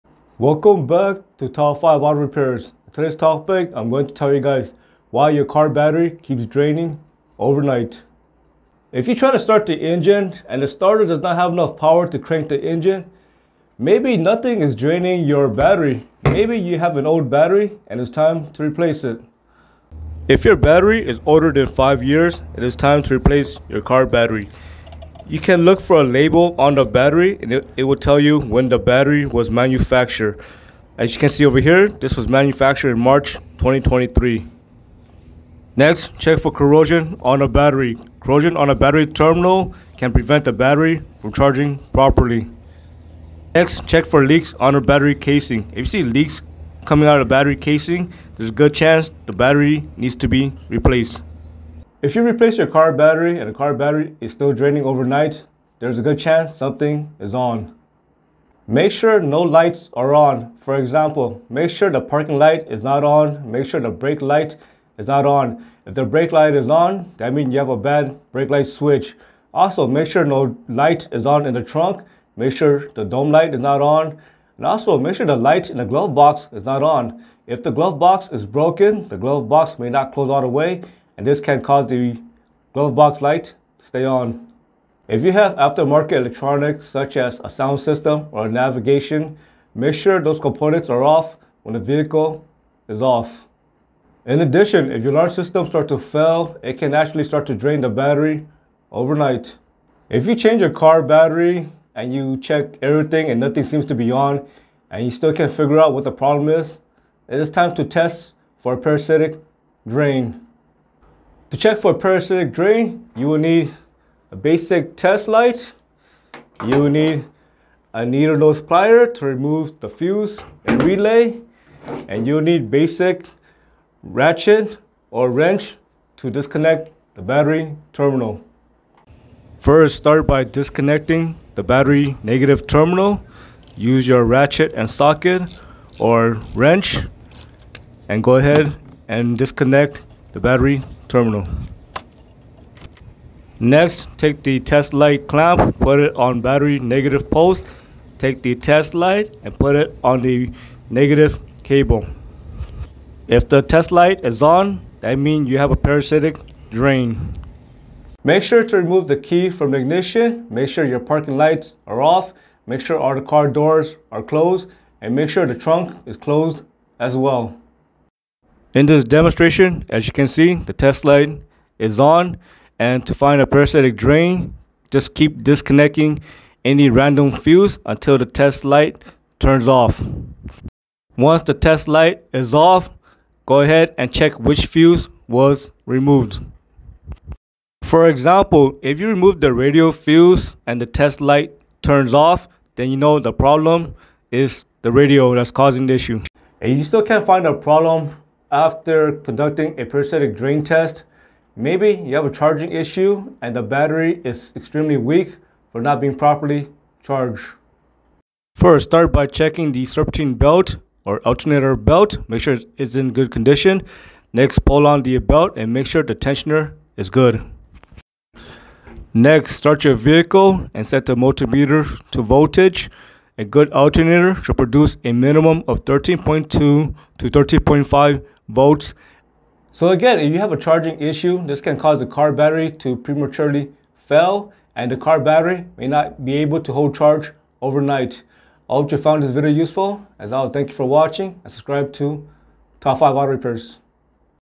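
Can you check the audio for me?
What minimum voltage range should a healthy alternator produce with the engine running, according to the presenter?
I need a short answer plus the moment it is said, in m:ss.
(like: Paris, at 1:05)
13.2 to 13.5 volts, at 3:45.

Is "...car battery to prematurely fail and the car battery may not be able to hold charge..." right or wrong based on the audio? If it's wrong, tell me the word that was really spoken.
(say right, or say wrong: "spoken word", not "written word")
right.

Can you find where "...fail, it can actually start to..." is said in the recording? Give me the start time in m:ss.
1:35.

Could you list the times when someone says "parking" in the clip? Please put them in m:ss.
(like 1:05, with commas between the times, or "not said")
1:02, 2:40.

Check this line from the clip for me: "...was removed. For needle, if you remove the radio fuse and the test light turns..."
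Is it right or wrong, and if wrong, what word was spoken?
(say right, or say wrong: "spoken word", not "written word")
wrong: "example", not "needle".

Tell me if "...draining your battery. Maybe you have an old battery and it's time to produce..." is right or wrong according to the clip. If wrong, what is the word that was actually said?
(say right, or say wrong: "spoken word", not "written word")
wrong: "replace", not "produce".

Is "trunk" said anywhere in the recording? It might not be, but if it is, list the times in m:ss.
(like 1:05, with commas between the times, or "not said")
1:11, 2:45.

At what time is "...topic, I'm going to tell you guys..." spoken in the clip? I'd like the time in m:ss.
0:03.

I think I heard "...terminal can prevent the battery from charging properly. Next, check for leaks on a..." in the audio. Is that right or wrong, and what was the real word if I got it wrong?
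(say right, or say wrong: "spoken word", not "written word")
right.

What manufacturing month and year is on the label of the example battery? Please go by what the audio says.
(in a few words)
March 2023.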